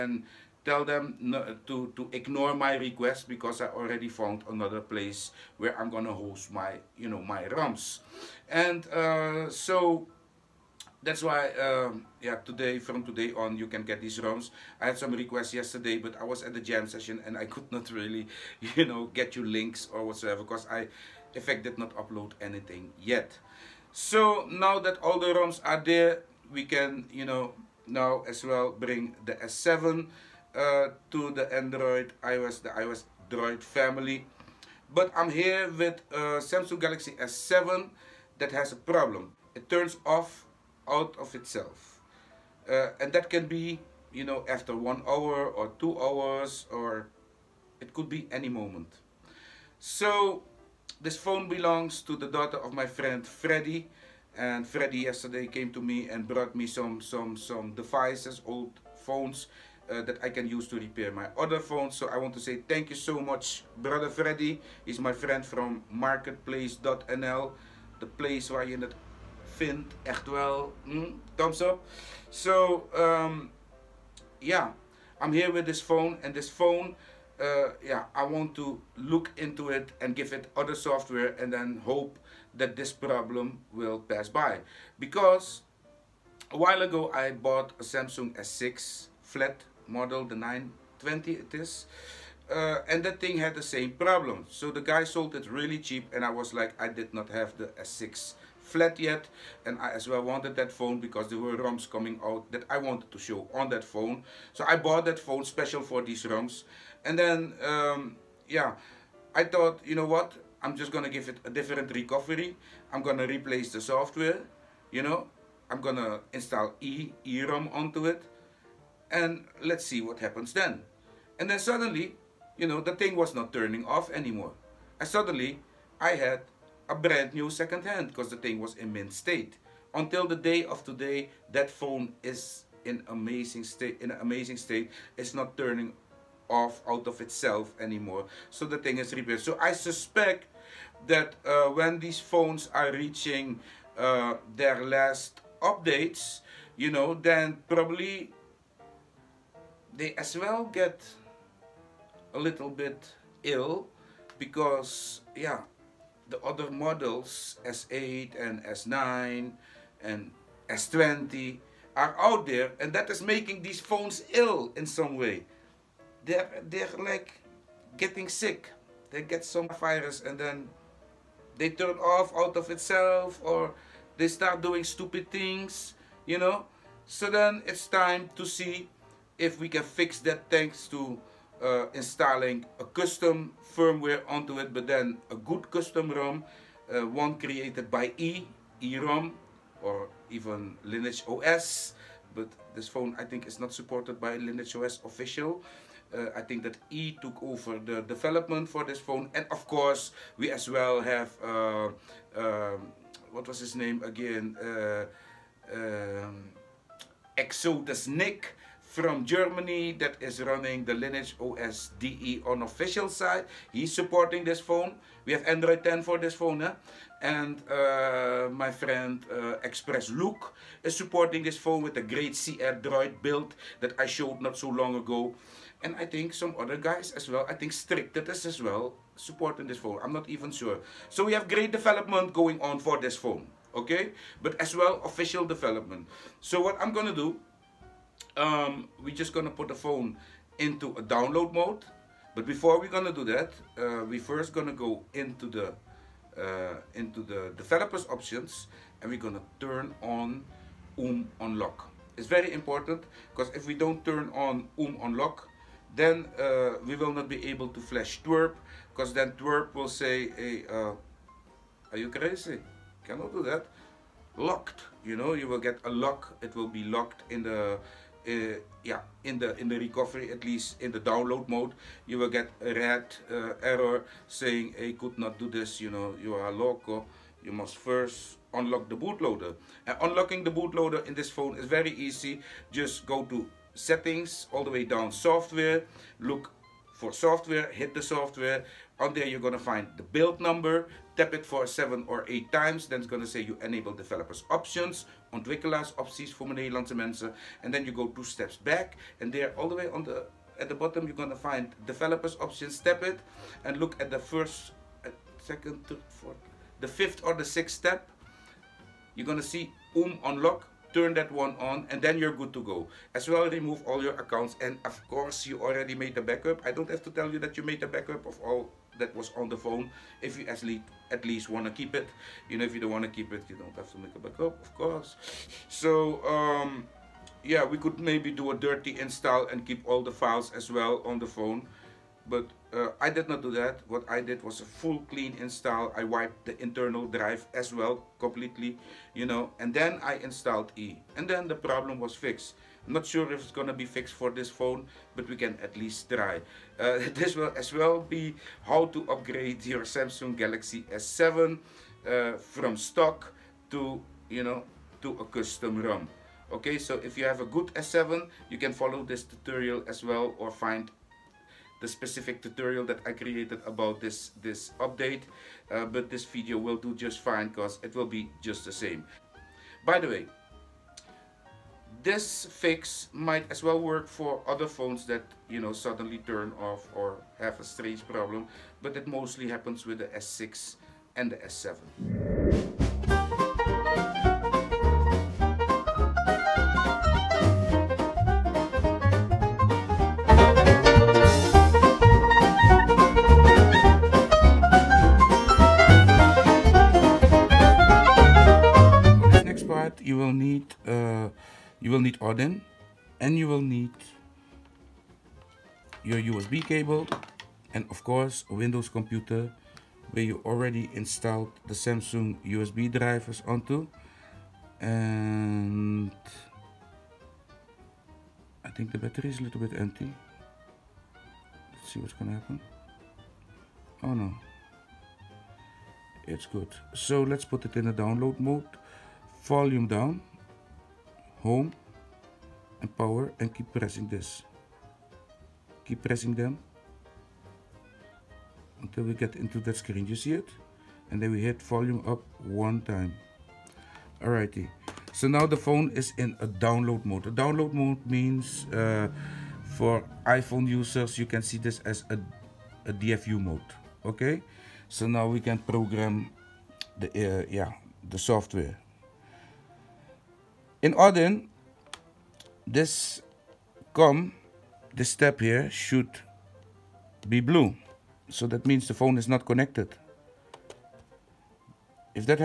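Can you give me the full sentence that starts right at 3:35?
We have Android 10 for this phone.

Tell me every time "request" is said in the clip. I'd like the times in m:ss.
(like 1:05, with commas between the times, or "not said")
0:02, 0:15.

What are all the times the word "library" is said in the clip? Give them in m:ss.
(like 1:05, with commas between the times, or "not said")
not said.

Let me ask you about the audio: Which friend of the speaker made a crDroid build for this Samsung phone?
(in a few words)
Express Luke.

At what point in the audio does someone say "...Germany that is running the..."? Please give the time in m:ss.
3:29.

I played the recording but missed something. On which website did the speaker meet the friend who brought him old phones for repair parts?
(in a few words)
marktplaats.nl.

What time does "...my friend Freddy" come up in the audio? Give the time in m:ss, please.
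0:52.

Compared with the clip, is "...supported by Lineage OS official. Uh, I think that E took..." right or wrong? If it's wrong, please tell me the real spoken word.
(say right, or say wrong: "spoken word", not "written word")
right.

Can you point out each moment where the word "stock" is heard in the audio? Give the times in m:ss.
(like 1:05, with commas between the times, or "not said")
5:52.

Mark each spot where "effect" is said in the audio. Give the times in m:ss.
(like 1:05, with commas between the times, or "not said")
0:21.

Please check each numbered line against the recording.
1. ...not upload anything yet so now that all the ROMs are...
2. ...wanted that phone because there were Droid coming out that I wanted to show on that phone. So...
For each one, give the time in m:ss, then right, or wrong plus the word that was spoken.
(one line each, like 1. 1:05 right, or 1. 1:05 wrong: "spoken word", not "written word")
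1. 0:21 right
2. 1:40 wrong: "ROMs", not "Droid".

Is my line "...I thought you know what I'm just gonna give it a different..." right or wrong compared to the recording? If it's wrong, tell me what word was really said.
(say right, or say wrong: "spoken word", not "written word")
right.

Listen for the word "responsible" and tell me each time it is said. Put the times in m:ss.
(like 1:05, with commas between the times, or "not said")
not said.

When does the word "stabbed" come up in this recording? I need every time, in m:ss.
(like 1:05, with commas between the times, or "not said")
not said.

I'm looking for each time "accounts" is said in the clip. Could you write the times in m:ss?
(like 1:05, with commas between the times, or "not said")
5:14.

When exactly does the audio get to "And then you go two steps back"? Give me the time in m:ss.
4:57.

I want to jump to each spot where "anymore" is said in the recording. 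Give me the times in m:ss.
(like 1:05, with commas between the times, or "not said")
2:04, 2:17.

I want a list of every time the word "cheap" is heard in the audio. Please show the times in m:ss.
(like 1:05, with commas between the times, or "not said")
1:35.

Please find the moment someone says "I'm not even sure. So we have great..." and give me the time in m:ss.
3:50.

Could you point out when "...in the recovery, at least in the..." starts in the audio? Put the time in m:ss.
4:29.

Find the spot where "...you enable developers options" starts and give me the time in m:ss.
4:53.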